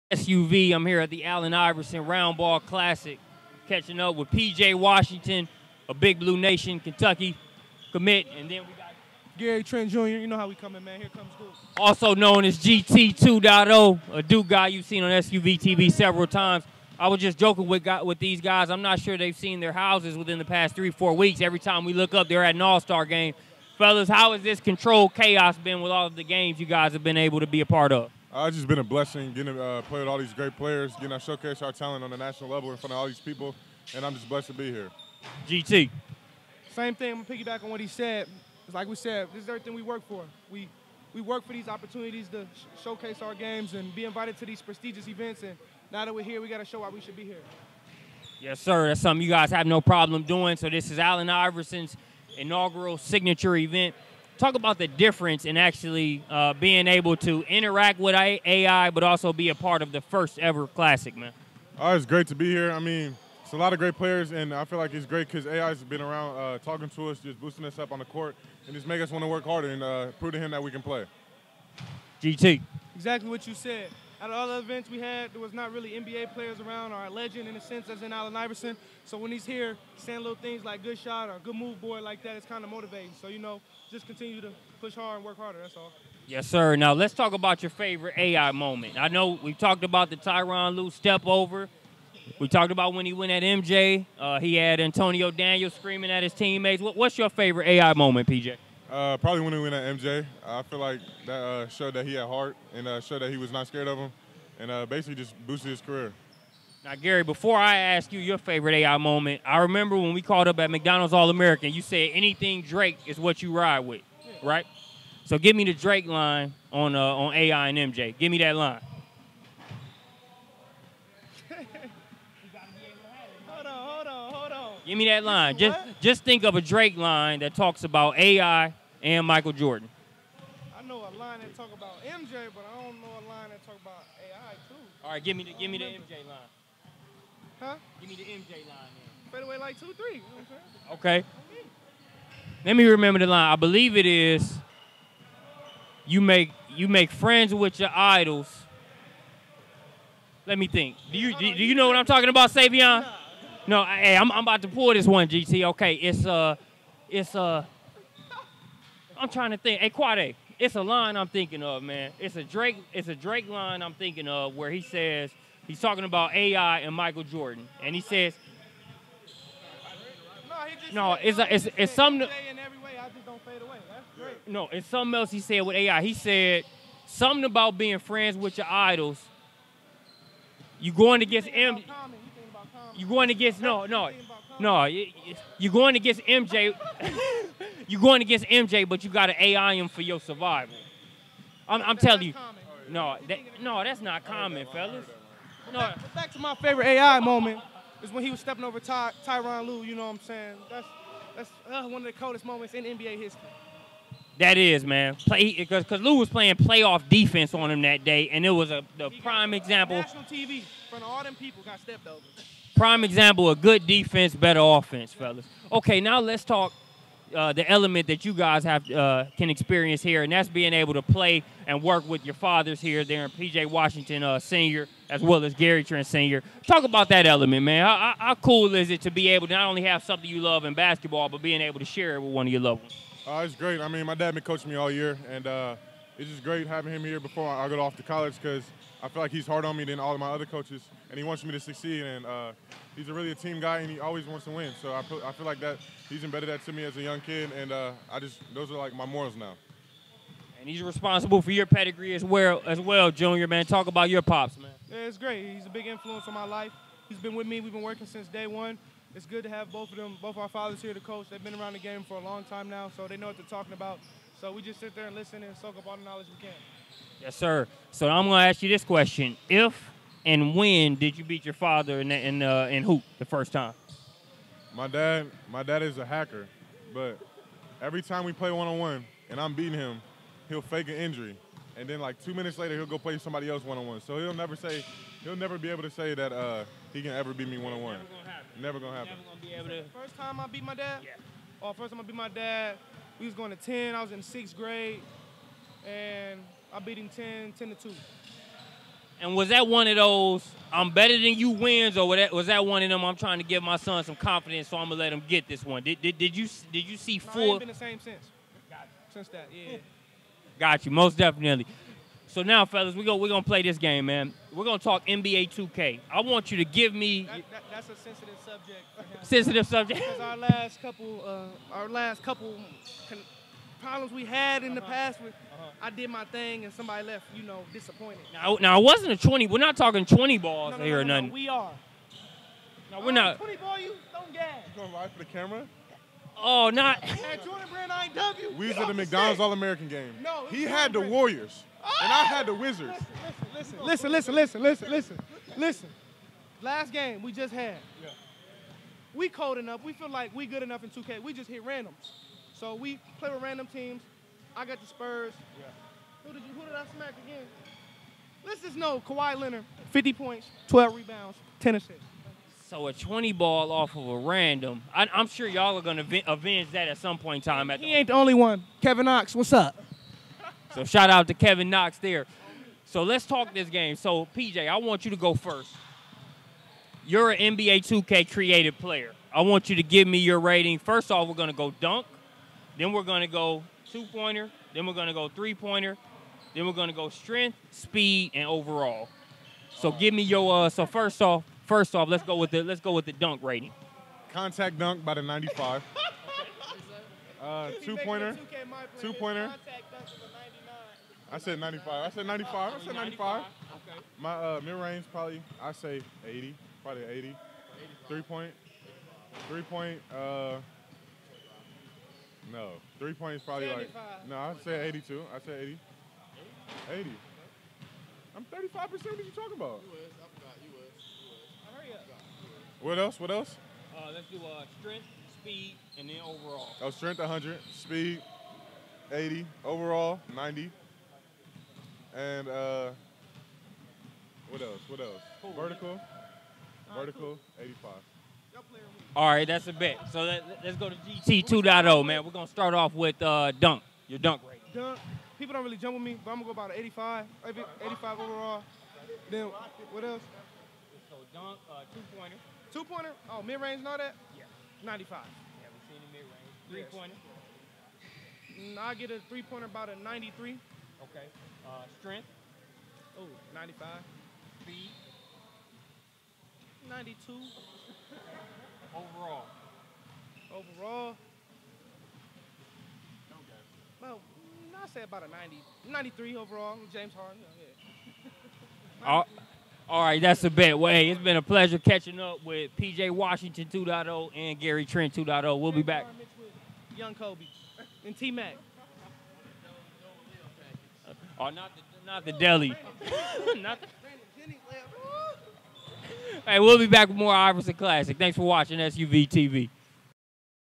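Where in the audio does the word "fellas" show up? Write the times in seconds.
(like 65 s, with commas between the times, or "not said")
23 s, 194 s, 215 s, 312 s.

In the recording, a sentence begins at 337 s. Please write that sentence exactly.
had Jordan Brand, I ain't We was at the McDonald's All American game.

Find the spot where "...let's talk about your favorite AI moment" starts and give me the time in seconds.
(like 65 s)
86 s.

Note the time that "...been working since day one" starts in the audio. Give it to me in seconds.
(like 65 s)
257 s.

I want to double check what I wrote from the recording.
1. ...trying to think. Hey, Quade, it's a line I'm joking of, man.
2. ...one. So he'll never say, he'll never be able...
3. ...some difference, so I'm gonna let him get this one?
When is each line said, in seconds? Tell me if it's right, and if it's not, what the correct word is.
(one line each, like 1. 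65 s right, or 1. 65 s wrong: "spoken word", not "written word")
1. 159 s wrong: "thinking", not "joking"
2. 283 s right
3. 304 s wrong: "confidence", not "difference".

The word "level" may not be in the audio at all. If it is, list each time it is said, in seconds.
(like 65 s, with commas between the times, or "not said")
32 s.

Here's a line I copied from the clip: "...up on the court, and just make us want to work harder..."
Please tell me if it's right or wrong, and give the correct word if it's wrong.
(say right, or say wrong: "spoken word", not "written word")
right.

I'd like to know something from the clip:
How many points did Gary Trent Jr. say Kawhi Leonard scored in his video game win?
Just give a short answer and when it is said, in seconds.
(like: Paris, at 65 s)
50, at 359 s.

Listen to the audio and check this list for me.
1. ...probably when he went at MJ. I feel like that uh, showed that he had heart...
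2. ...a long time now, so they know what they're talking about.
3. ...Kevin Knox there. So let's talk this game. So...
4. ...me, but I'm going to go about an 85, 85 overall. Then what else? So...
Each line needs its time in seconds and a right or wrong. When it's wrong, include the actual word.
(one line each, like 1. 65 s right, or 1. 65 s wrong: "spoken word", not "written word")
1. 99 s right
2. 262 s right
3. 371 s right
4. 446 s right.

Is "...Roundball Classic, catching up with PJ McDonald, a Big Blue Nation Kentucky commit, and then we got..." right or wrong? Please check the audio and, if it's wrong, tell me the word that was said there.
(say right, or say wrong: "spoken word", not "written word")
wrong: "Washington", not "McDonald".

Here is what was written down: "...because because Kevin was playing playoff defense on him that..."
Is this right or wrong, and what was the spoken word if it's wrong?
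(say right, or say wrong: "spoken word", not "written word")
wrong: "Lue", not "Kevin".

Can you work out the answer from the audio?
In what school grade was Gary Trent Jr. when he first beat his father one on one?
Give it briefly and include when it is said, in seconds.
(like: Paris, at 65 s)
sixth grade, at 294 s.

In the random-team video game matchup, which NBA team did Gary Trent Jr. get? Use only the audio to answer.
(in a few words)
Spurs.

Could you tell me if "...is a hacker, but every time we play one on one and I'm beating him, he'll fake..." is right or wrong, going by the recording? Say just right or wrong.
right.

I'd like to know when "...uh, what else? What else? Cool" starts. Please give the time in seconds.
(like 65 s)
432 s.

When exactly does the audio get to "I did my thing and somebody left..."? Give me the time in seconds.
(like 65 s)
325 s.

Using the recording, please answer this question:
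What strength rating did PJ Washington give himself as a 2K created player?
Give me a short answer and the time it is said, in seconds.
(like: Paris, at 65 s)
100, at 426 s.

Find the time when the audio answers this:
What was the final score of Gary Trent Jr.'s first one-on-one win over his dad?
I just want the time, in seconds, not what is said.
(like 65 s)
297 s.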